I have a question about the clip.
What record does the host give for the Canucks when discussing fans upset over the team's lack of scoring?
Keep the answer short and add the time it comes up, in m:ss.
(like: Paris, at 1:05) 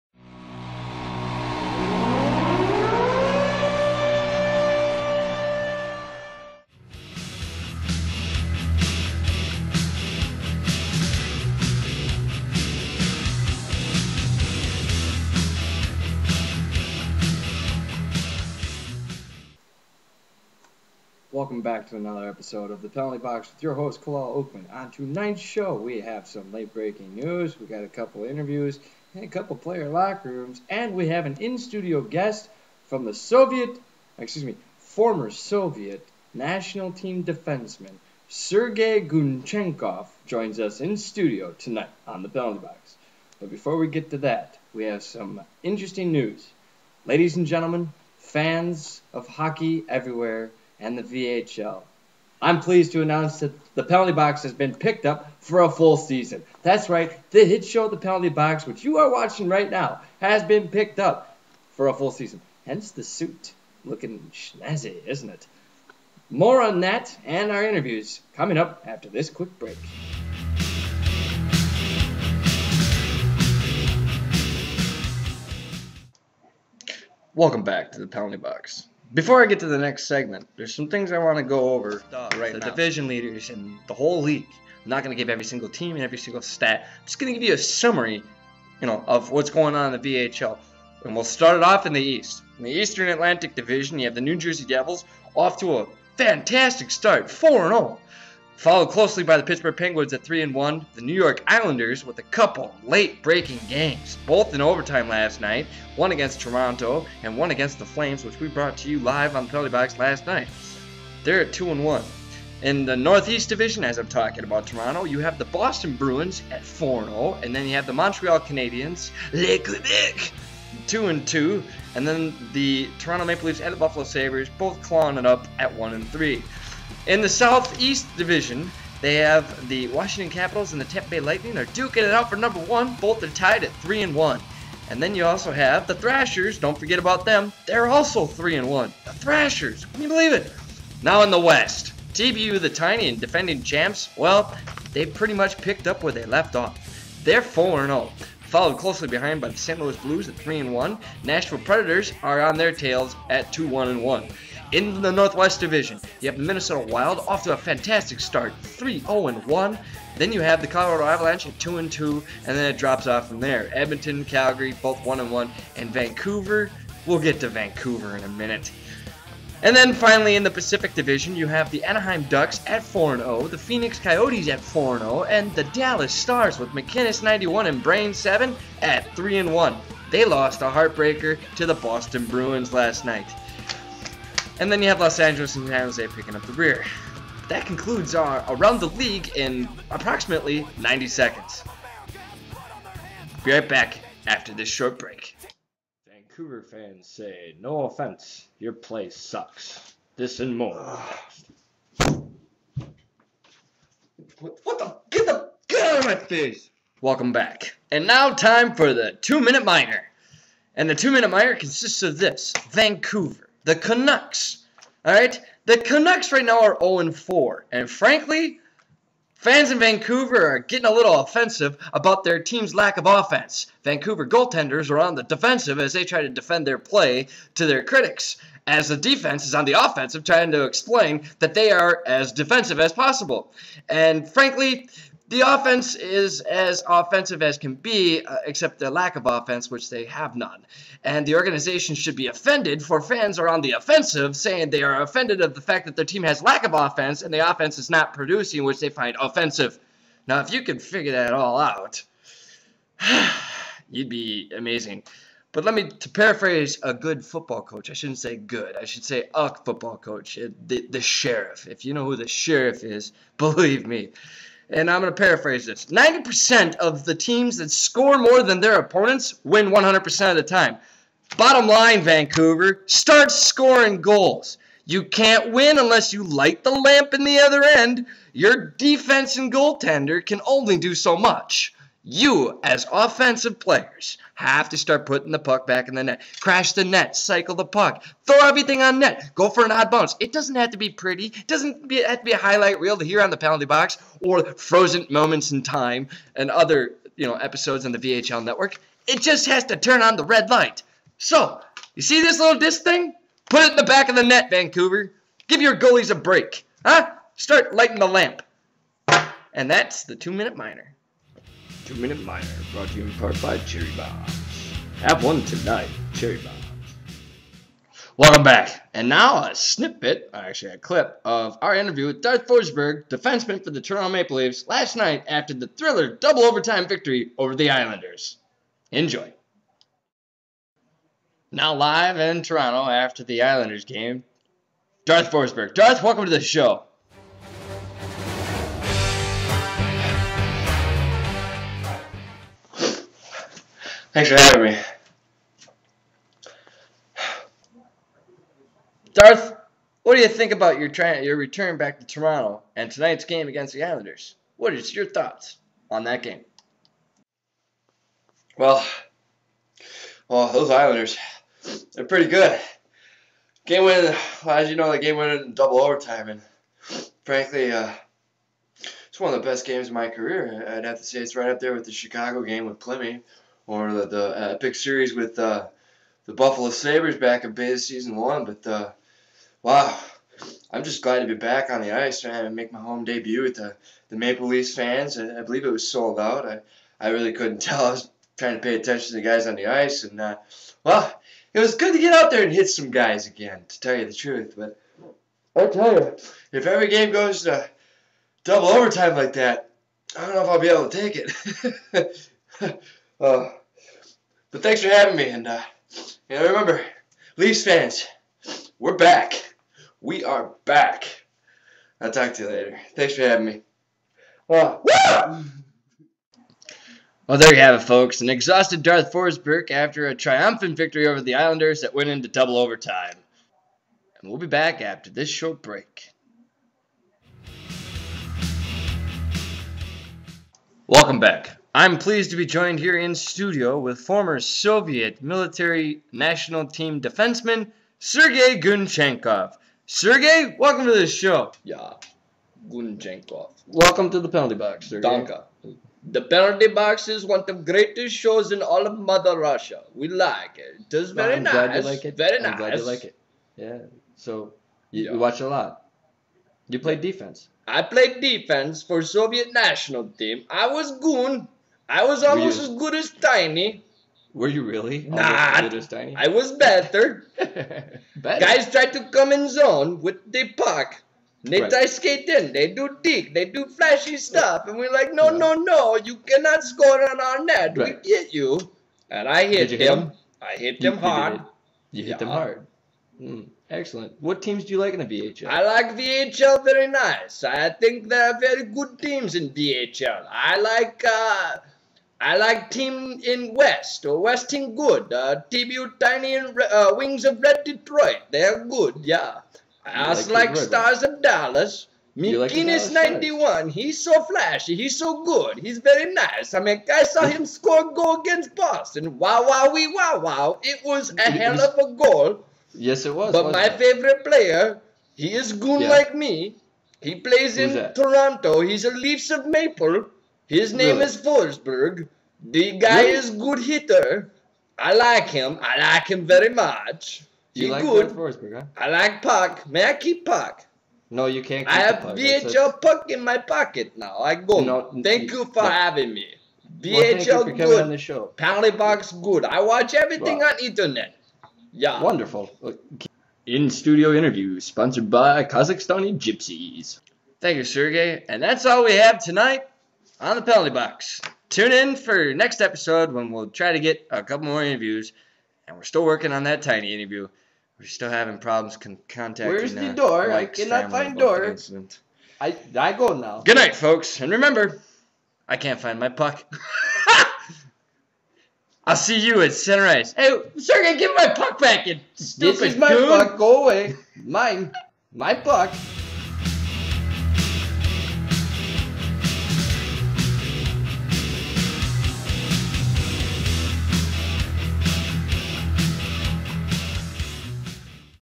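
0 and 4, at 3:36.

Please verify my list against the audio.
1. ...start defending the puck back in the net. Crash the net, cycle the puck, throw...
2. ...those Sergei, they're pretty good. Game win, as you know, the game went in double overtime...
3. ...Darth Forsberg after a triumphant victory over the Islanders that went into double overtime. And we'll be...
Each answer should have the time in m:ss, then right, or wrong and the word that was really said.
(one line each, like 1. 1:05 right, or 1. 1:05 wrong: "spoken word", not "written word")
1. 4:44 wrong: "putting", not "defending"
2. 6:00 wrong: "Islanders", not "Sergei"
3. 6:58 right.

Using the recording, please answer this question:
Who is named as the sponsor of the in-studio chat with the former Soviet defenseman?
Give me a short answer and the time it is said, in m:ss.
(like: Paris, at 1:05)
Kazakhstani Gypsies, at 9:05.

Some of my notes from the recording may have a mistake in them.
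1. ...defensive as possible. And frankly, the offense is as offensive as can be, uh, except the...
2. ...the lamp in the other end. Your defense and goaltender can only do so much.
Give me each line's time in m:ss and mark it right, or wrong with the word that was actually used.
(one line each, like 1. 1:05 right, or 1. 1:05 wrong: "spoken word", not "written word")
1. 3:52 right
2. 4:36 right.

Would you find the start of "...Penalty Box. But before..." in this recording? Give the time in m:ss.
0:42.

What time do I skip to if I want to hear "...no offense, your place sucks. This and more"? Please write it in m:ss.
3:17.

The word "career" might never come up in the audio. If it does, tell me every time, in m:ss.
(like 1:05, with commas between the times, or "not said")
6:10.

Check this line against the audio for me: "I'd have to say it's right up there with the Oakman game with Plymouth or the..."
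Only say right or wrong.
wrong.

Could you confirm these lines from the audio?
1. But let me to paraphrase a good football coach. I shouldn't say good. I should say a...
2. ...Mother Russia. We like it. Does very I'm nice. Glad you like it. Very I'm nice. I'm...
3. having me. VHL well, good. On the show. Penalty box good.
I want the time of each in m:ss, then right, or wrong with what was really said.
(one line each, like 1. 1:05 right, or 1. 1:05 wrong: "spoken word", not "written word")
1. 4:15 right
2. 7:28 right
3. 8:55 right.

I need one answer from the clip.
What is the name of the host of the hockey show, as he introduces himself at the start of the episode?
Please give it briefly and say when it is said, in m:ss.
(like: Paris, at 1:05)
Kalal Oakman, at 0:24.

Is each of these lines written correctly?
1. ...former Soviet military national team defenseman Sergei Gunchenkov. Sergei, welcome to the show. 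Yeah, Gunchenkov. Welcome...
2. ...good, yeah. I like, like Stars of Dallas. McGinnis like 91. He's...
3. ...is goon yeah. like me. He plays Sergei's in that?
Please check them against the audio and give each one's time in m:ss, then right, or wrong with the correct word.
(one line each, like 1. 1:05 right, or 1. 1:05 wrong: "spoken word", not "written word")
1. 7:13 right
2. 8:18 right
3. 8:35 wrong: "Who", not "Sergei".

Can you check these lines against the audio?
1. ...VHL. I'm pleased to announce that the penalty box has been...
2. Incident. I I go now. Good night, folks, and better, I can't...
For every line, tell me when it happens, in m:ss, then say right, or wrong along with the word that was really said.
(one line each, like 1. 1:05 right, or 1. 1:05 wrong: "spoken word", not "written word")
1. 0:51 right
2. 9:21 wrong: "remember", not "better".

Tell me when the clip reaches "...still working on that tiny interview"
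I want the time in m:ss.
9:15.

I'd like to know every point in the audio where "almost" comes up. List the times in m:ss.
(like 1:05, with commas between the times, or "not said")
7:42.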